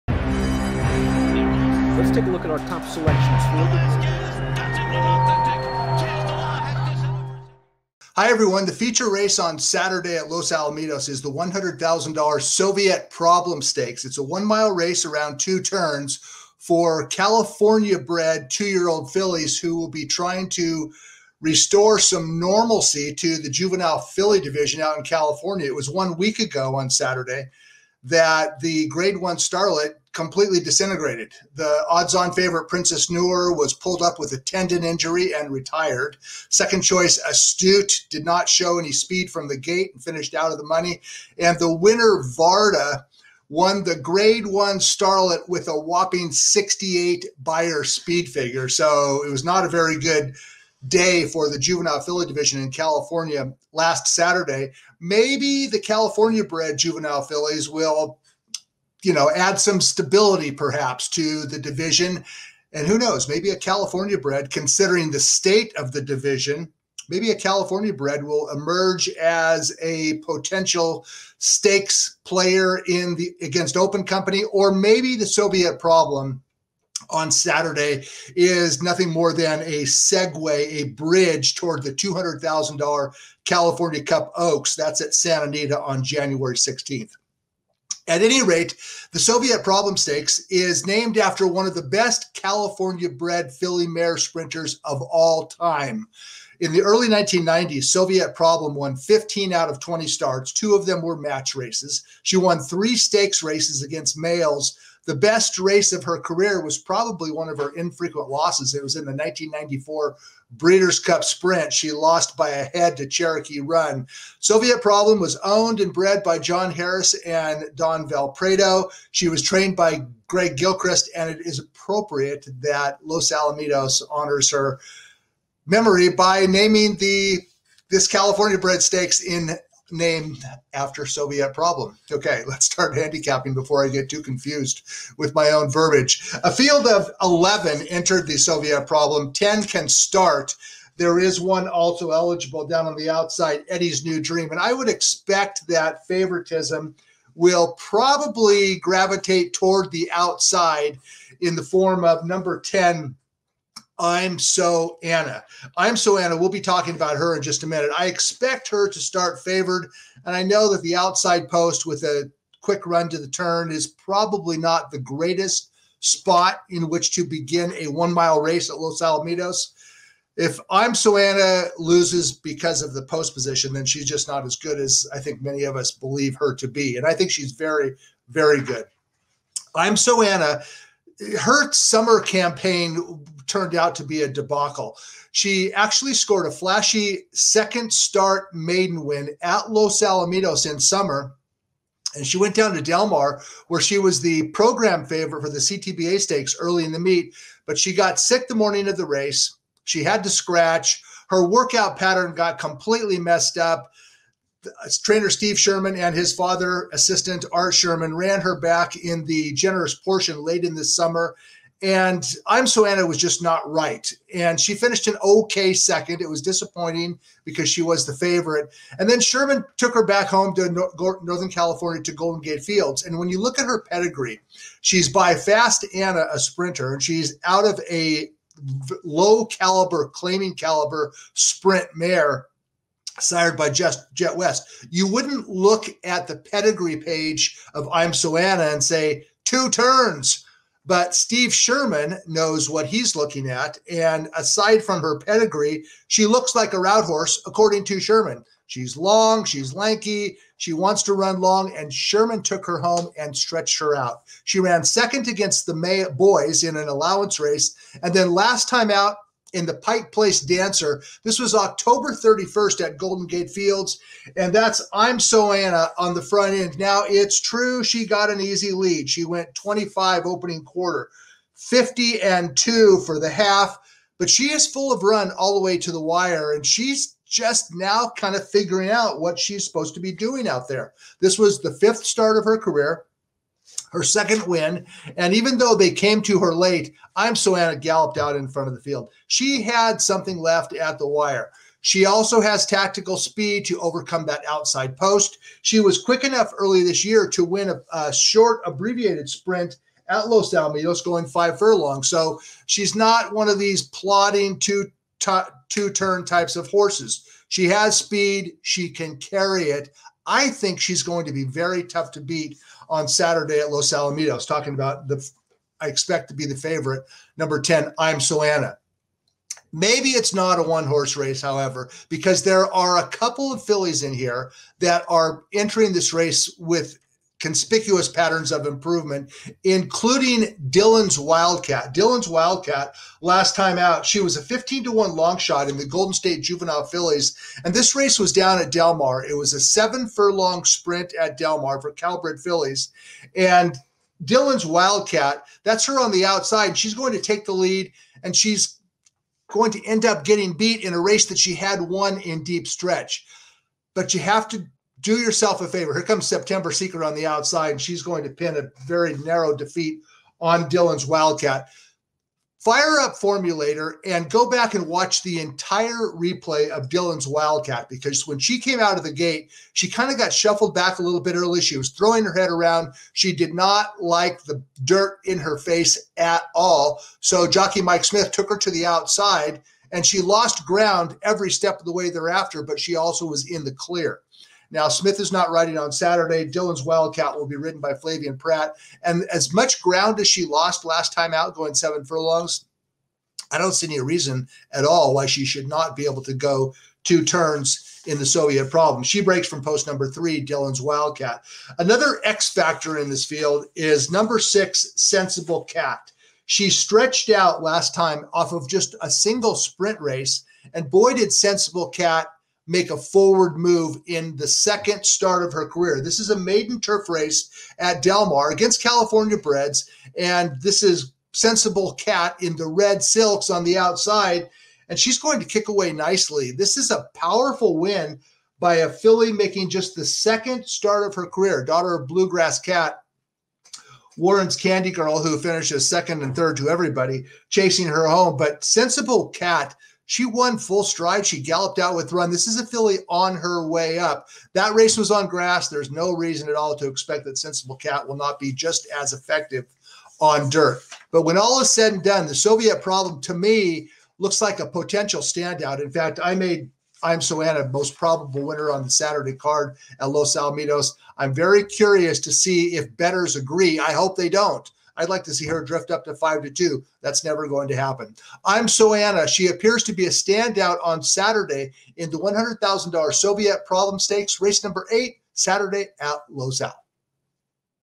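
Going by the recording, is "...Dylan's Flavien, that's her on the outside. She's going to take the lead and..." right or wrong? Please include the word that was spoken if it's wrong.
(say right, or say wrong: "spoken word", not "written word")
wrong: "Wildcat", not "Flavien".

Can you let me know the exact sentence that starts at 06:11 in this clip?
She was throwing her head around.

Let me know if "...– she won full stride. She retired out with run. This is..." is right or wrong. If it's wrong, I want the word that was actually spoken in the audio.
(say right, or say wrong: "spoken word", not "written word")
wrong: "galloped", not "retired".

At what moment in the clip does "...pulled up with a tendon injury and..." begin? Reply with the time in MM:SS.
00:33.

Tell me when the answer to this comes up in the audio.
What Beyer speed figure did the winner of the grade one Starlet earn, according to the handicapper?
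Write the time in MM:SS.
00:46.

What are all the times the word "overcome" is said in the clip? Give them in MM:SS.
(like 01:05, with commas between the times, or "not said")
04:53.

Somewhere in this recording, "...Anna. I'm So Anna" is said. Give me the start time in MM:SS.
02:35.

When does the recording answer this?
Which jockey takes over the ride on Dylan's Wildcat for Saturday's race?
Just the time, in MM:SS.
06:27.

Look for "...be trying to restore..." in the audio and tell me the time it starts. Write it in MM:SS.
00:19.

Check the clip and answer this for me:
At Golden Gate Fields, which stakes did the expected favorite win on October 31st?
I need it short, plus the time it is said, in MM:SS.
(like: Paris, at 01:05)
Pike Place Dancer, at 04:19.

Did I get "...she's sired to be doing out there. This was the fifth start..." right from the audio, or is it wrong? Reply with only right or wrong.
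wrong.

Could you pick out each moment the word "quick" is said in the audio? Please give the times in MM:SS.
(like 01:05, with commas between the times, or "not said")
02:42, 04:56.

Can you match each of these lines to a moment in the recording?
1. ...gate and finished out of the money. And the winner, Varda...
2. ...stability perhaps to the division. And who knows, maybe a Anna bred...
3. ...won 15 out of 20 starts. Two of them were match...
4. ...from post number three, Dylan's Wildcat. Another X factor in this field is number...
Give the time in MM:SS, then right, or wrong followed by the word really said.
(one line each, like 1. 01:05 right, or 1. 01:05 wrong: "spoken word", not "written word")
1. 00:39 right
2. 00:59 wrong: "California", not "Anna"
3. 01:38 right
4. 06:39 right.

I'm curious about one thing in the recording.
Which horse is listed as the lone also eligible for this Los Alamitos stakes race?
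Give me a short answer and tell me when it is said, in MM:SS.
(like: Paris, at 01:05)
Eddie's New Dream, at 02:23.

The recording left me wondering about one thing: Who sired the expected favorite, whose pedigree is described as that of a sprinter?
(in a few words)
Fast Anna.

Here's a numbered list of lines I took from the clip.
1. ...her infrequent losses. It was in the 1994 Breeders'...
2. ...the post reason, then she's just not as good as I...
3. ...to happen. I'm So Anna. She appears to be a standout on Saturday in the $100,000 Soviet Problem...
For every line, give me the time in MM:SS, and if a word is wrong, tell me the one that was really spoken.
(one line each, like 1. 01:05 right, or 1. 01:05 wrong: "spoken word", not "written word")
1. 01:47 right
2. 02:52 wrong: "position", not "reason"
3. 07:47 right.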